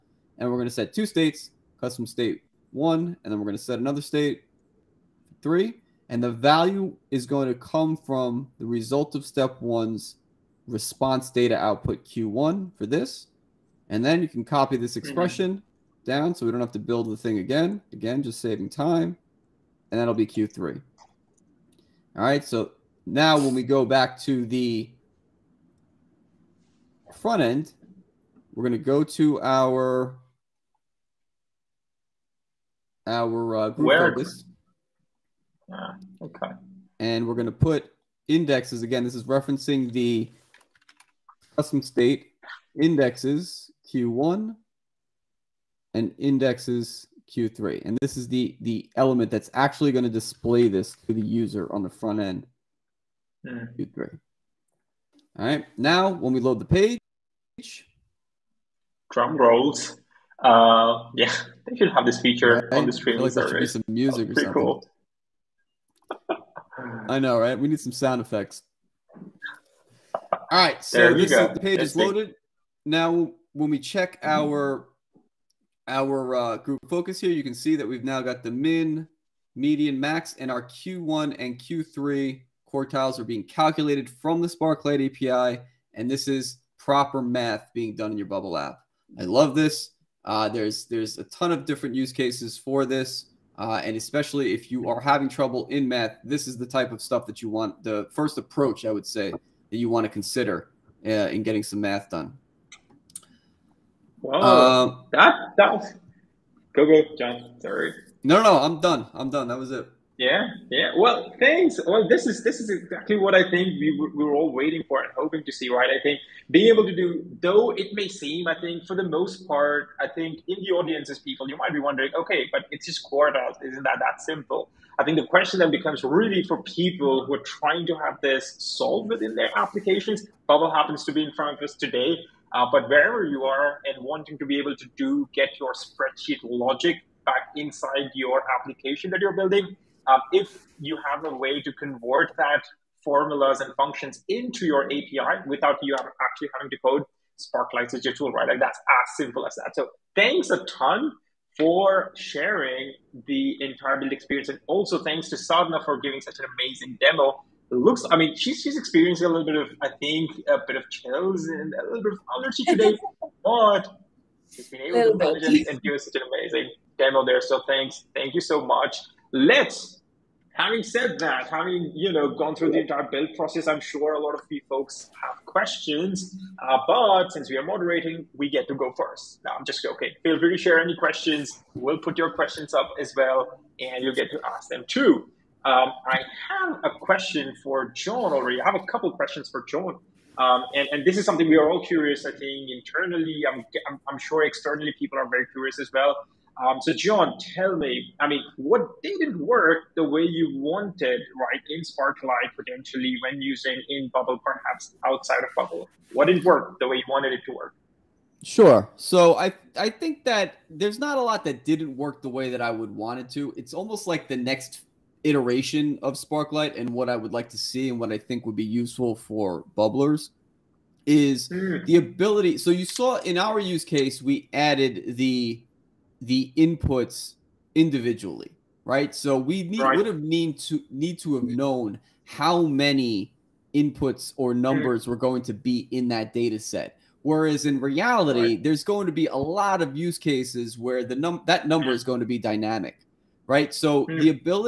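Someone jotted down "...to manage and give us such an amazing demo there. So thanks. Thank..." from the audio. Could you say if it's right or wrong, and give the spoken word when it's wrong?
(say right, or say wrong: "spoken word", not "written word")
right.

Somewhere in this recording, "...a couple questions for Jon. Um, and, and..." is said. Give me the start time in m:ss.
3:08.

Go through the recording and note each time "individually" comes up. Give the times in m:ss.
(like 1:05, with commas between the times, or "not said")
3:47.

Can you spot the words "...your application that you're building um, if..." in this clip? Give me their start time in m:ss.
2:18.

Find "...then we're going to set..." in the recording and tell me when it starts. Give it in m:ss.
0:03.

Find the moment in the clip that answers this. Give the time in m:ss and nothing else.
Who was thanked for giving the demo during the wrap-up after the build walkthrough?
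2:35.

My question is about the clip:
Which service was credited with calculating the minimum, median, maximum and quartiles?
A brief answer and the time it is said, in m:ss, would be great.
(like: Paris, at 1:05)
Sparklite API, at 1:24.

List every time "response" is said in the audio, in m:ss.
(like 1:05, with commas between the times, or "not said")
0:10.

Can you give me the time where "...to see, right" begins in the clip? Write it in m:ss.
1:55.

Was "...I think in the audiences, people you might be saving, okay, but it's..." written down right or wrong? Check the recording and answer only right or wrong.
wrong.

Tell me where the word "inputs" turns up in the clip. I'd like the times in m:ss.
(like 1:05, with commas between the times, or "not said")
3:46, 3:53.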